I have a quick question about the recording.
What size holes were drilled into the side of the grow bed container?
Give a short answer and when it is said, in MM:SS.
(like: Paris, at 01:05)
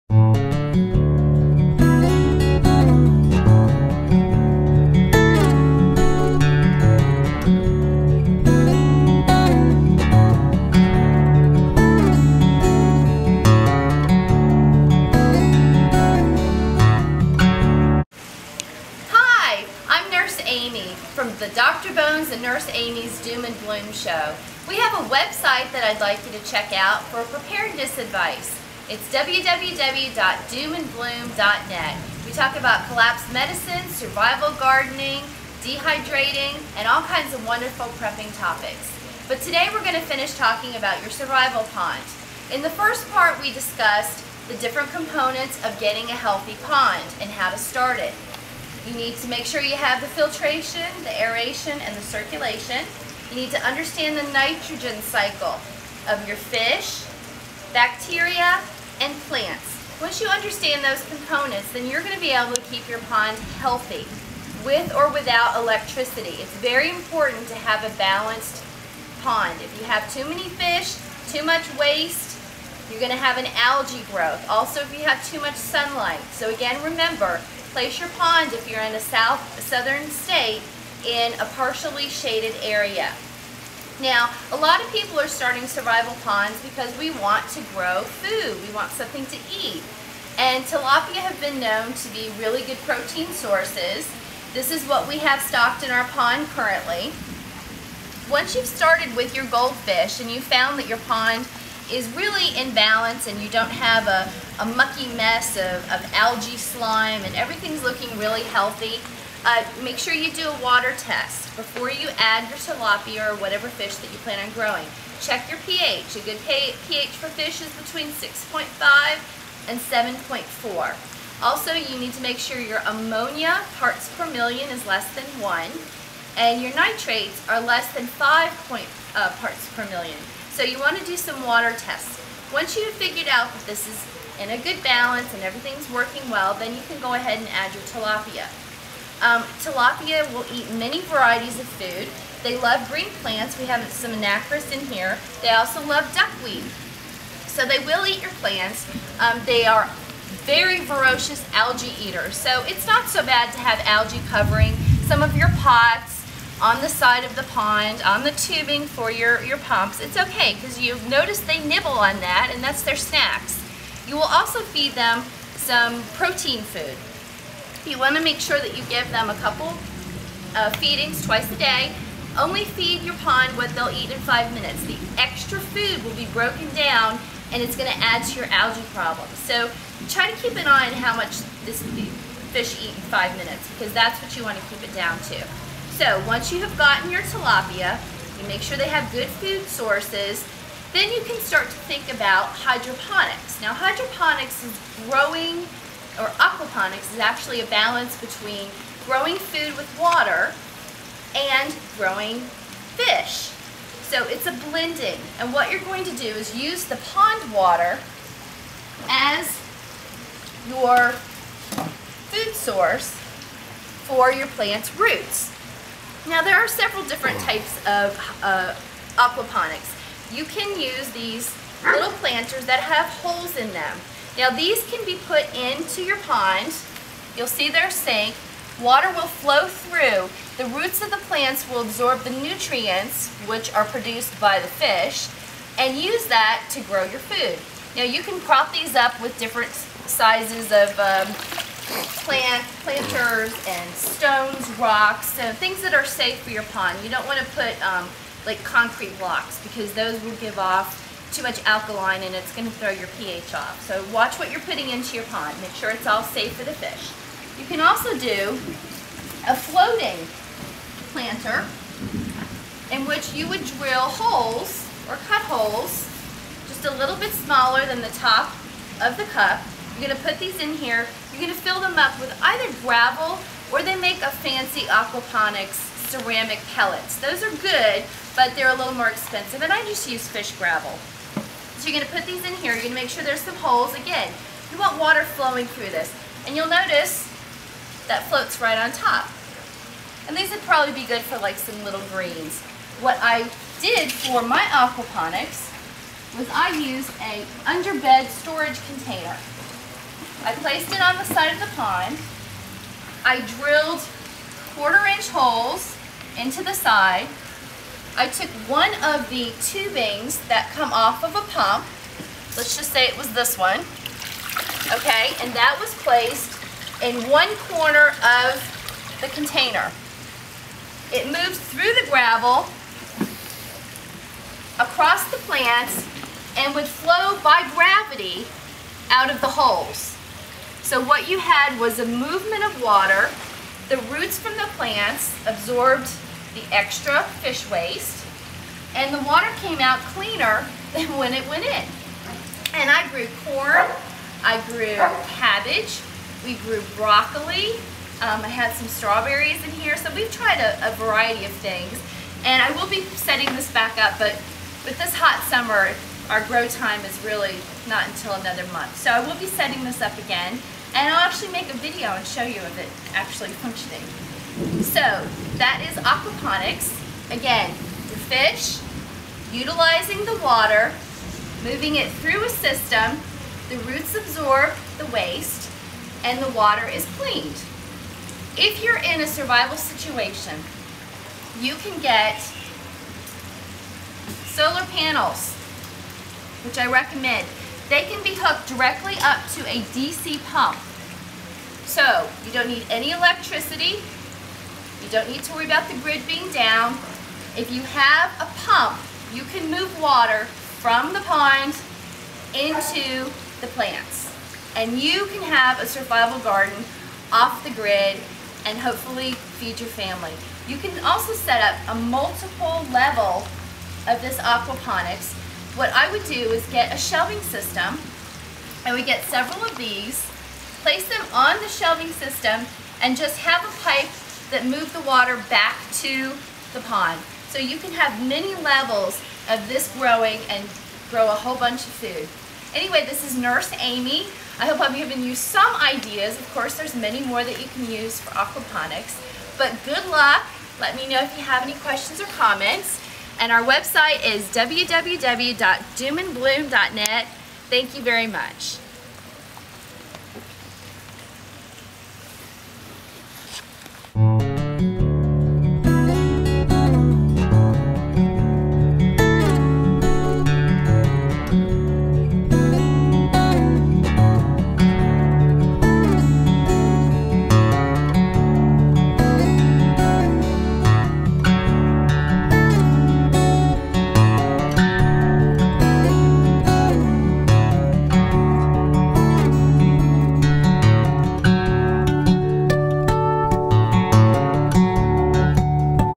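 Quarter inch, at 05:04.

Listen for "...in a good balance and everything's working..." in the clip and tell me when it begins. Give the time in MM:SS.
02:14.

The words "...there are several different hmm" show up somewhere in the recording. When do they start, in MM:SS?
03:36.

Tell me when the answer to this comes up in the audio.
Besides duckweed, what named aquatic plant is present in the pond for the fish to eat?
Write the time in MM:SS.
02:24.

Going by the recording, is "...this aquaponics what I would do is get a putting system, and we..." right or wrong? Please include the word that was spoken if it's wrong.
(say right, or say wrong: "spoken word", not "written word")
wrong: "shelving", not "putting".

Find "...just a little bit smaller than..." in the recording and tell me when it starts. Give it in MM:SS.
04:26.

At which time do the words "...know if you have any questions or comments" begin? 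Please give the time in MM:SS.
07:21.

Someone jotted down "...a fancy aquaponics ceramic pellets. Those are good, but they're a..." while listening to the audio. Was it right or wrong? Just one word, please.
right.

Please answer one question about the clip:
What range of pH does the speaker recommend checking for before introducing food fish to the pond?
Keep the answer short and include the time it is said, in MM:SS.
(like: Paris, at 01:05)
6.5 to 7.4, at 01:57.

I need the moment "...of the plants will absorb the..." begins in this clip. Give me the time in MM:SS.
03:51.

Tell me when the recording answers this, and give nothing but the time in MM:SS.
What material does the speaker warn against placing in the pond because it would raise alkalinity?
04:08.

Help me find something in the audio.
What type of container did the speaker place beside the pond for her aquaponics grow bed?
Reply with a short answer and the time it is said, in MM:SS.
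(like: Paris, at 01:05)
Underbed storage container, at 04:57.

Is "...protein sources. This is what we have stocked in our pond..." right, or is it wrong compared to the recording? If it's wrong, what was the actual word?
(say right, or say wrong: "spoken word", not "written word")
right.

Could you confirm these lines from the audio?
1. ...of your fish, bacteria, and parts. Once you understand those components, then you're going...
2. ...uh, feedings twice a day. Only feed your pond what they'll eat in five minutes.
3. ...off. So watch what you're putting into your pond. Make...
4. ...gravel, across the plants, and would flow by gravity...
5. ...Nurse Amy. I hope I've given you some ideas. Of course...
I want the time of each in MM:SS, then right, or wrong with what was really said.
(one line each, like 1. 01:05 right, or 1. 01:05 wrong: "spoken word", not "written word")
1. 00:56 wrong: "plants", not "parts"
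2. 02:50 right
3. 04:13 right
4. 05:22 right
5. 07:13 right.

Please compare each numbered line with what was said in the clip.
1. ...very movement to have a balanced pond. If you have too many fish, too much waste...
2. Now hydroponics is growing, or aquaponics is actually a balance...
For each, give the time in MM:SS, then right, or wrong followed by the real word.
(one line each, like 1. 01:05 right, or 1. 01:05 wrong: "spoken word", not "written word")
1. 01:06 wrong: "important", not "movement"
2. 03:13 right.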